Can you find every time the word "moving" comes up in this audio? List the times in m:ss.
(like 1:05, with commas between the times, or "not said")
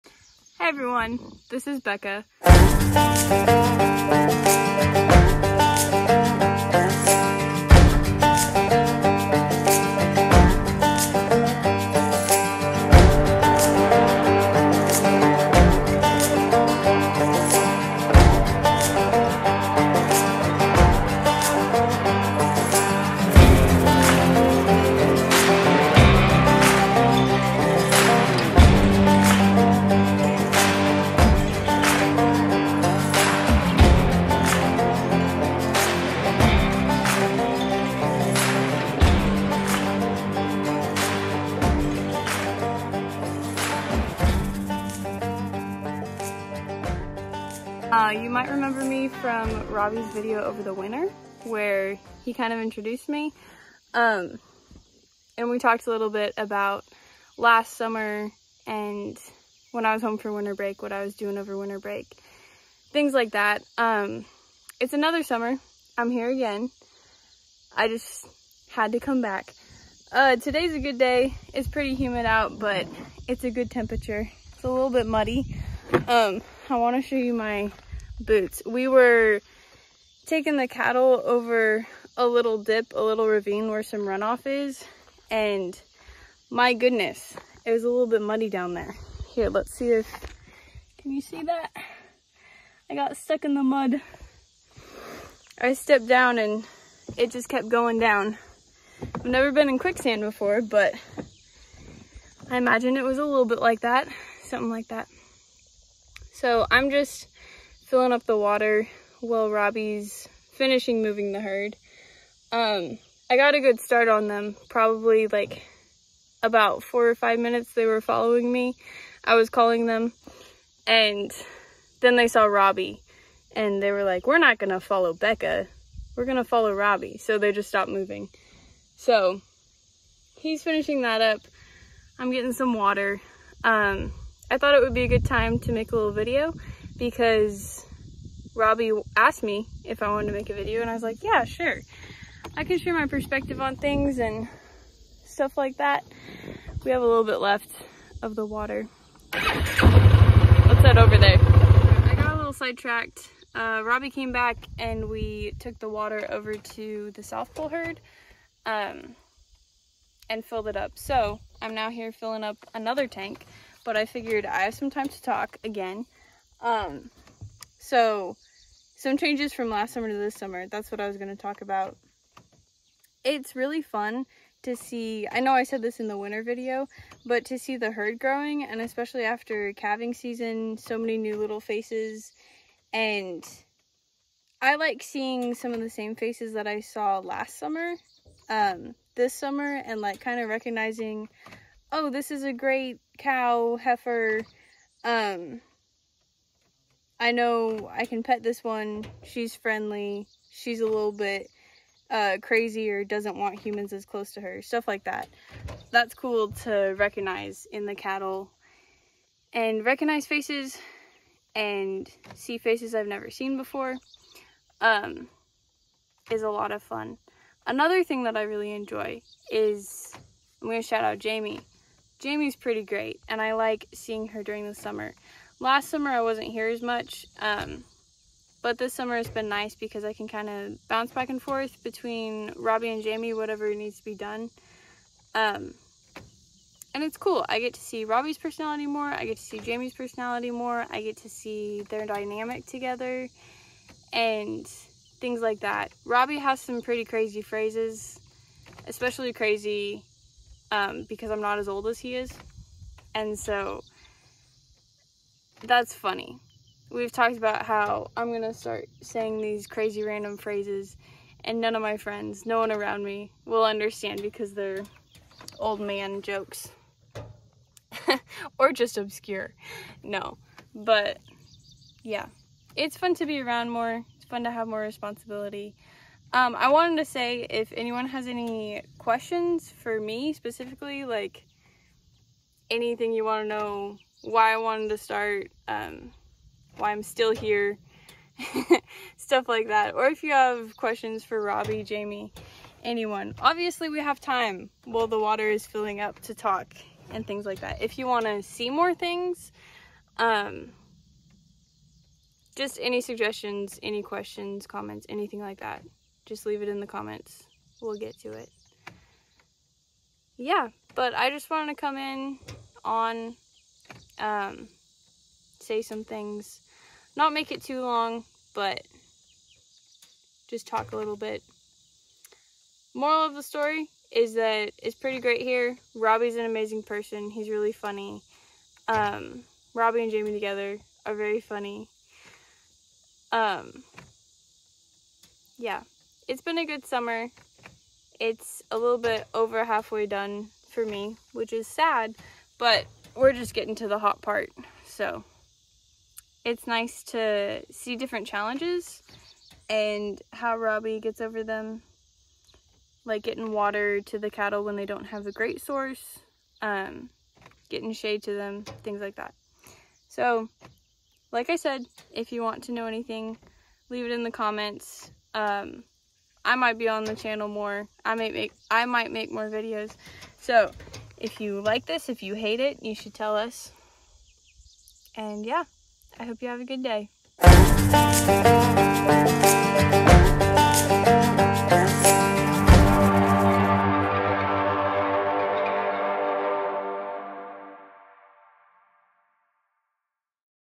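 1:51, 2:07.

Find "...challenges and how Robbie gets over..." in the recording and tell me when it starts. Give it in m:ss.
5:48.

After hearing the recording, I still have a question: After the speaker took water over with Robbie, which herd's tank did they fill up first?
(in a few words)
South Poll.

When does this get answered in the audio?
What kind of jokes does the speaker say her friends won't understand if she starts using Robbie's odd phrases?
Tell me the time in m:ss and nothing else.
4:25.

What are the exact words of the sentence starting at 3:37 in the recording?
Another thing that I really enjoy is, I'm going to shout out Jamie.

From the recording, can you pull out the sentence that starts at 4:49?
Or if you have questions for Robbie, Jamie, anyone.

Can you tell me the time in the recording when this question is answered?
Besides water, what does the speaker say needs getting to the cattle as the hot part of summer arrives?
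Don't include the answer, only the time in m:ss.
5:57.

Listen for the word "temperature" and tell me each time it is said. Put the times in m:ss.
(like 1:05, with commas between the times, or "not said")
1:13.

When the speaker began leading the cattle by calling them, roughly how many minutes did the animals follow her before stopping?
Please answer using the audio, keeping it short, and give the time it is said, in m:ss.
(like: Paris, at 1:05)
4 or 5 minutes, at 1:56.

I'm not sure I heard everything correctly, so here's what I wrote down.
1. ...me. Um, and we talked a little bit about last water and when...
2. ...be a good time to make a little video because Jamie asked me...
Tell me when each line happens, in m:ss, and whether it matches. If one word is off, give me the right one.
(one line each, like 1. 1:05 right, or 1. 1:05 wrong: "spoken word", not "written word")
1. 0:53 wrong: "summer", not "water"
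2. 2:14 wrong: "Robbie", not "Jamie".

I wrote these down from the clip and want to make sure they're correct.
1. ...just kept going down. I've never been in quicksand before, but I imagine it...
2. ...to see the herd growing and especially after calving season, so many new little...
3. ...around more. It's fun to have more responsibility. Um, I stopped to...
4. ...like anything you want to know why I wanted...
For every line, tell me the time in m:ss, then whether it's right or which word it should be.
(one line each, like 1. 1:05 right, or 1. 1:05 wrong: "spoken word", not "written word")
1. 1:37 right
2. 2:57 right
3. 4:33 wrong: "wanted", not "stopped"
4. 4:41 right.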